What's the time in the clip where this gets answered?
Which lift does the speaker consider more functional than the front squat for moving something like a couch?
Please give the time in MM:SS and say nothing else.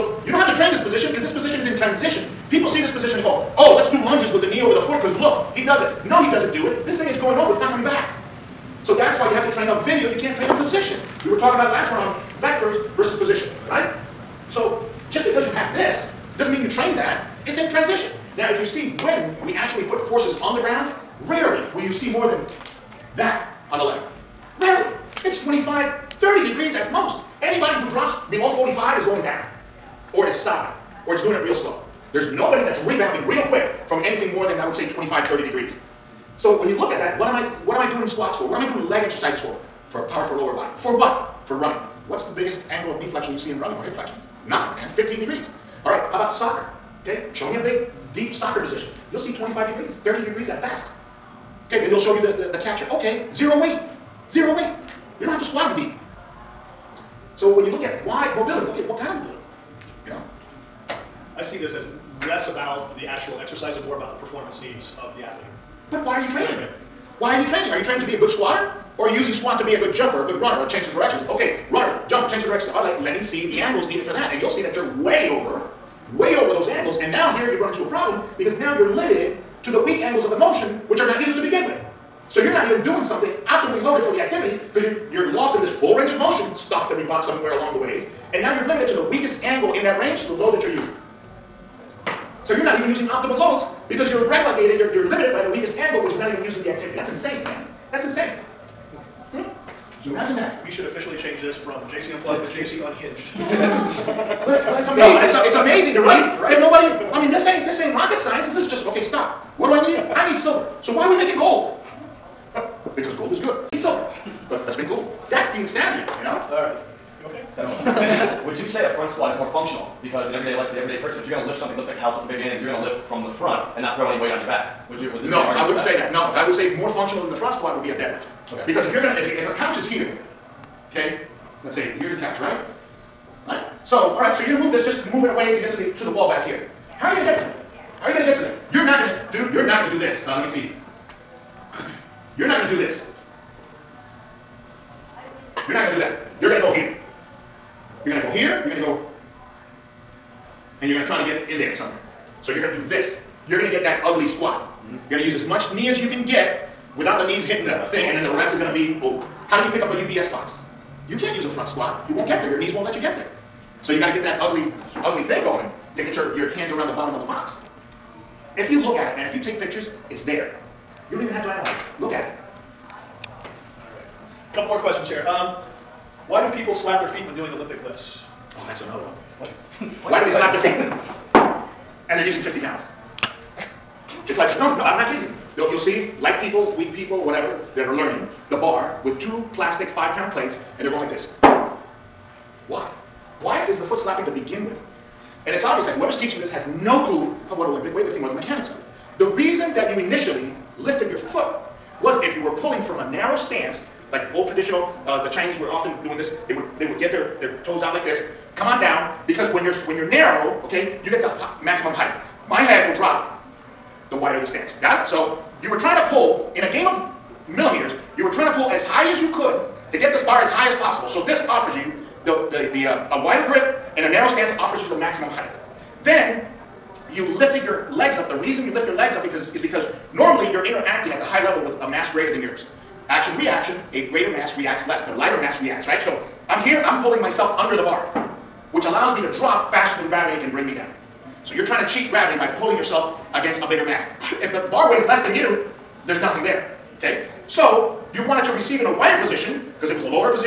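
02:07.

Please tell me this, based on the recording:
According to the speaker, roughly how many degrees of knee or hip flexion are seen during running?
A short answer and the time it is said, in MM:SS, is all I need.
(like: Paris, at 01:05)
15 degrees, at 00:44.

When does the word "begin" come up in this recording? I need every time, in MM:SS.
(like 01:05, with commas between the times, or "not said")
01:21, 03:14.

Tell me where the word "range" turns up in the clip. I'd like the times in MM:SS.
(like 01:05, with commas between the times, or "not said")
01:25, 01:29.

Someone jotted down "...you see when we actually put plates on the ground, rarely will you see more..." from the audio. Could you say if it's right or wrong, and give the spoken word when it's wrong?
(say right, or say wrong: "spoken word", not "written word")
wrong: "forces", not "plates".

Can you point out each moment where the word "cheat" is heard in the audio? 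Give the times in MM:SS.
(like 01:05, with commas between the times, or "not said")
04:01.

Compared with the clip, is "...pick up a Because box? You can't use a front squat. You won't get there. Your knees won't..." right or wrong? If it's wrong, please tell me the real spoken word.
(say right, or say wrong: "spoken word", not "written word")
wrong: "UPS", not "Because".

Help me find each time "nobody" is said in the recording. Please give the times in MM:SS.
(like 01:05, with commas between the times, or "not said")
00:32, 01:46.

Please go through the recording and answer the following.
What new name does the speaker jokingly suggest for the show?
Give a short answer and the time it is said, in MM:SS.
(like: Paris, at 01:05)
JC Unhinged, at 01:42.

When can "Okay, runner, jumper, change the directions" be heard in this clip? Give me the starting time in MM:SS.
01:11.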